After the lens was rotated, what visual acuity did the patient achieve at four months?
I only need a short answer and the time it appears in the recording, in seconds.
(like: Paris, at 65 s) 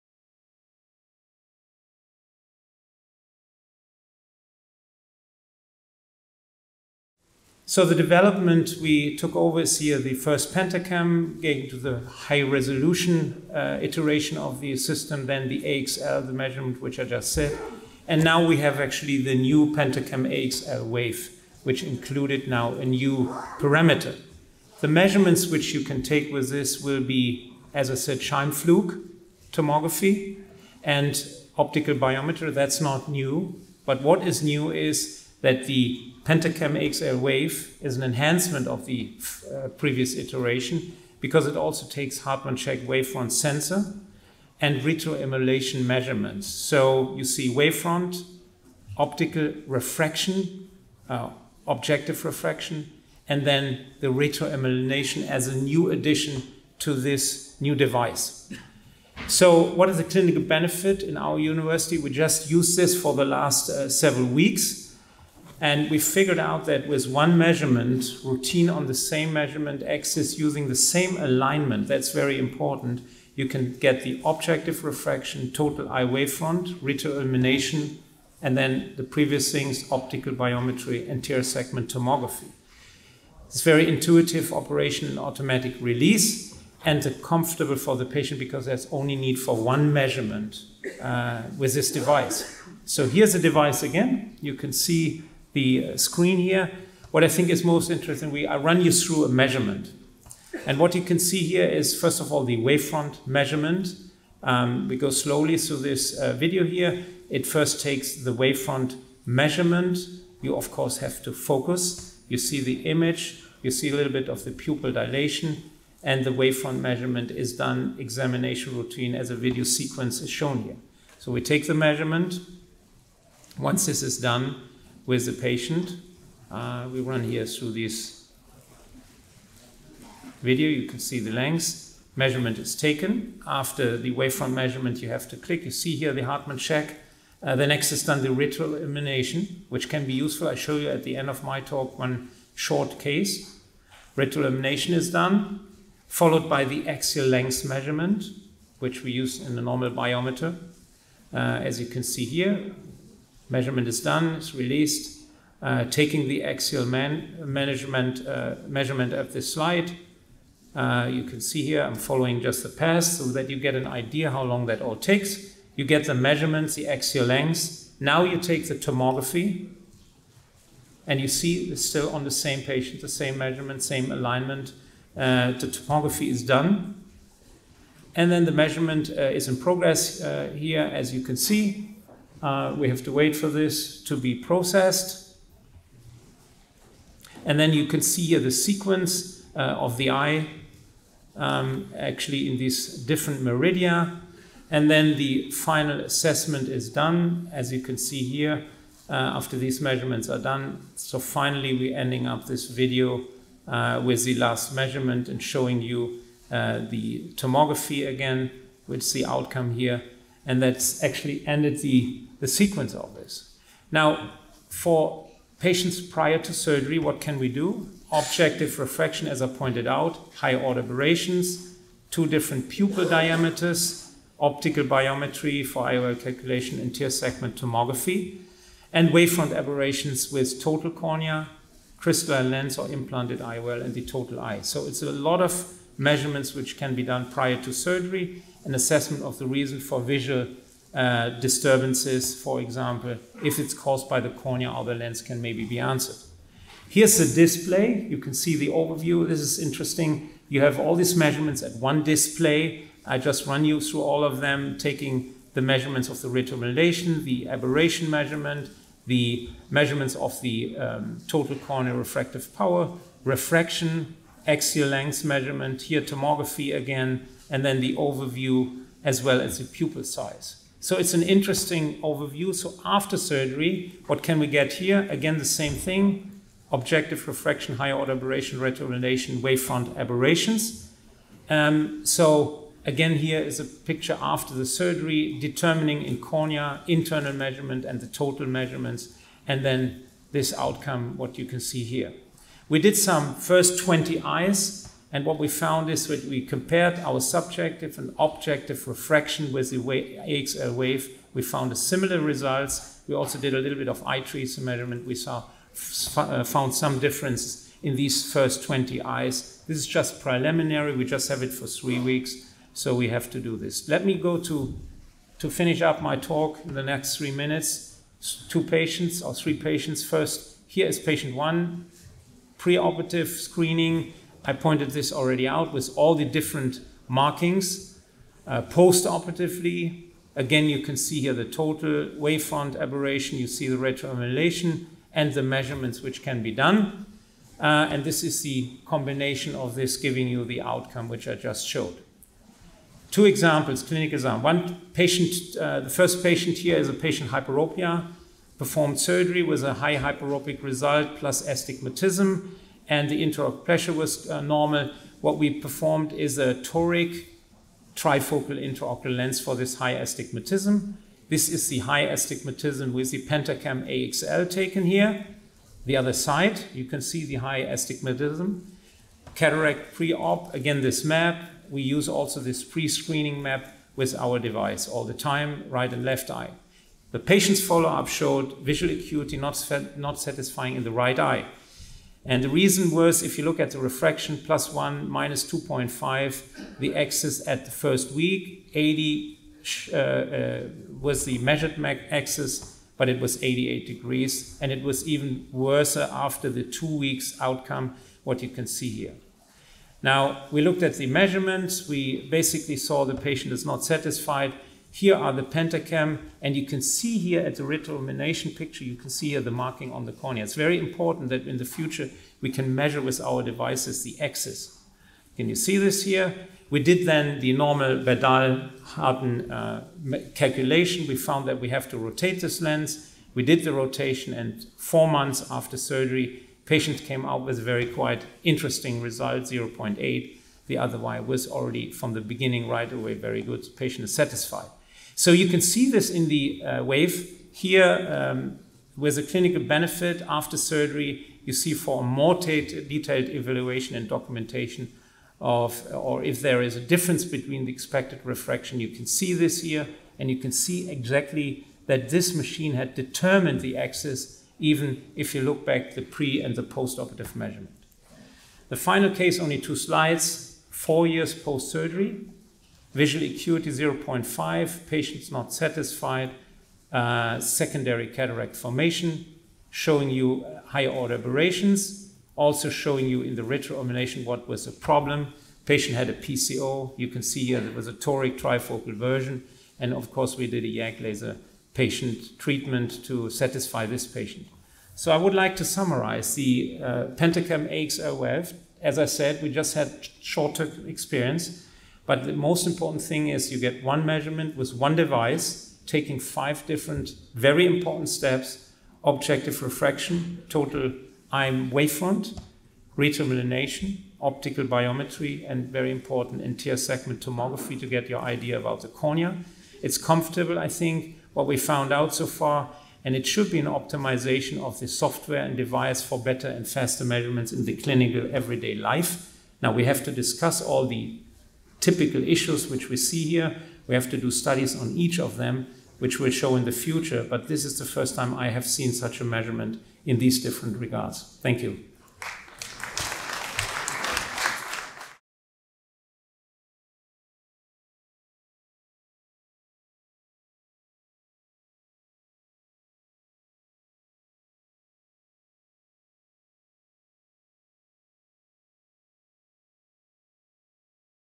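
0.8, at 429 s.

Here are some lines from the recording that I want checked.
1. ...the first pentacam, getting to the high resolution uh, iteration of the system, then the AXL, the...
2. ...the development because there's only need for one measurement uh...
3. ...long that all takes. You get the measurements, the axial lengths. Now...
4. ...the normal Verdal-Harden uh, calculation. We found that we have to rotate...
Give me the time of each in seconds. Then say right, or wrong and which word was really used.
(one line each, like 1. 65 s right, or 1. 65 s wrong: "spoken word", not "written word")
1. 9 s right
2. 87 s wrong: "patient", not "development"
3. 164 s right
4. 417 s right.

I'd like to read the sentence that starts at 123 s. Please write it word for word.
Once this is done, with the patient.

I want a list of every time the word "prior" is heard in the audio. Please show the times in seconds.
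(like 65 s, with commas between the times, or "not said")
216 s, 237 s.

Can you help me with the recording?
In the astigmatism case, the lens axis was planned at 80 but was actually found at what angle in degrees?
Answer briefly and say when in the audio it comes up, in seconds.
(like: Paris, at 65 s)
88, at 393 s.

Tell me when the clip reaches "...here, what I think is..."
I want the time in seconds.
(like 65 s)
96 s.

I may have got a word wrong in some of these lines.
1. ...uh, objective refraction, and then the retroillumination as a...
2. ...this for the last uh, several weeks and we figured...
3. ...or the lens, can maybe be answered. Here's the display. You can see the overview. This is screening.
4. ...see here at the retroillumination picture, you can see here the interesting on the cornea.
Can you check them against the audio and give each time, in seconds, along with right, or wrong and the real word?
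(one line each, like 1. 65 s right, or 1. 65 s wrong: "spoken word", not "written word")
1. 51 s right
2. 62 s right
3. 244 s wrong: "interesting", not "screening"
4. 406 s wrong: "marking", not "interesting".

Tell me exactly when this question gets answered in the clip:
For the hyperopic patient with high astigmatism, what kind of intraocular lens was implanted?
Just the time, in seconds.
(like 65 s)
356 s.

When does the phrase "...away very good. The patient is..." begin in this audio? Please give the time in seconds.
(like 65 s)
432 s.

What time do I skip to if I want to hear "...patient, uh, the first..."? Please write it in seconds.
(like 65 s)
344 s.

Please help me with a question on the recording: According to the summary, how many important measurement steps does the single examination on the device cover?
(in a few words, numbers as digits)
5.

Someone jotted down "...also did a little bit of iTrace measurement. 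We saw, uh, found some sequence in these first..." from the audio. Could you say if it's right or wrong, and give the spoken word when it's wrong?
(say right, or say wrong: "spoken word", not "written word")
wrong: "difference", not "sequence".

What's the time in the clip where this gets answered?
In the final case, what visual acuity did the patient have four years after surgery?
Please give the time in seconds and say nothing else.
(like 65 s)
463 s.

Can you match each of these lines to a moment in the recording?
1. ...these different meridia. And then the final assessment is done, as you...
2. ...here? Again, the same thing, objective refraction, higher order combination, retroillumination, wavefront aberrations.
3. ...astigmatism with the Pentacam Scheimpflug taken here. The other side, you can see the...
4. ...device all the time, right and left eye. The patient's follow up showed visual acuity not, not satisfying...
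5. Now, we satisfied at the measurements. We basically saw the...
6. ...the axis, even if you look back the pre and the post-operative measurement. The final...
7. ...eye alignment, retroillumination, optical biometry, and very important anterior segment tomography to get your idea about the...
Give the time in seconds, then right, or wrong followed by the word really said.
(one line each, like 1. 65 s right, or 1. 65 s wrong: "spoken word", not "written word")
1. 192 s right
2. 274 s wrong: "aberration", not "combination"
3. 362 s wrong: "AXL", not "Scheimpflug"
4. 374 s right
5. 400 s wrong: "looked", not "satisfied"
6. 453 s right
7. 501 s wrong: "wavefront", not "alignment".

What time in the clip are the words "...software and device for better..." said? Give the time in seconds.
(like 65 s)
514 s.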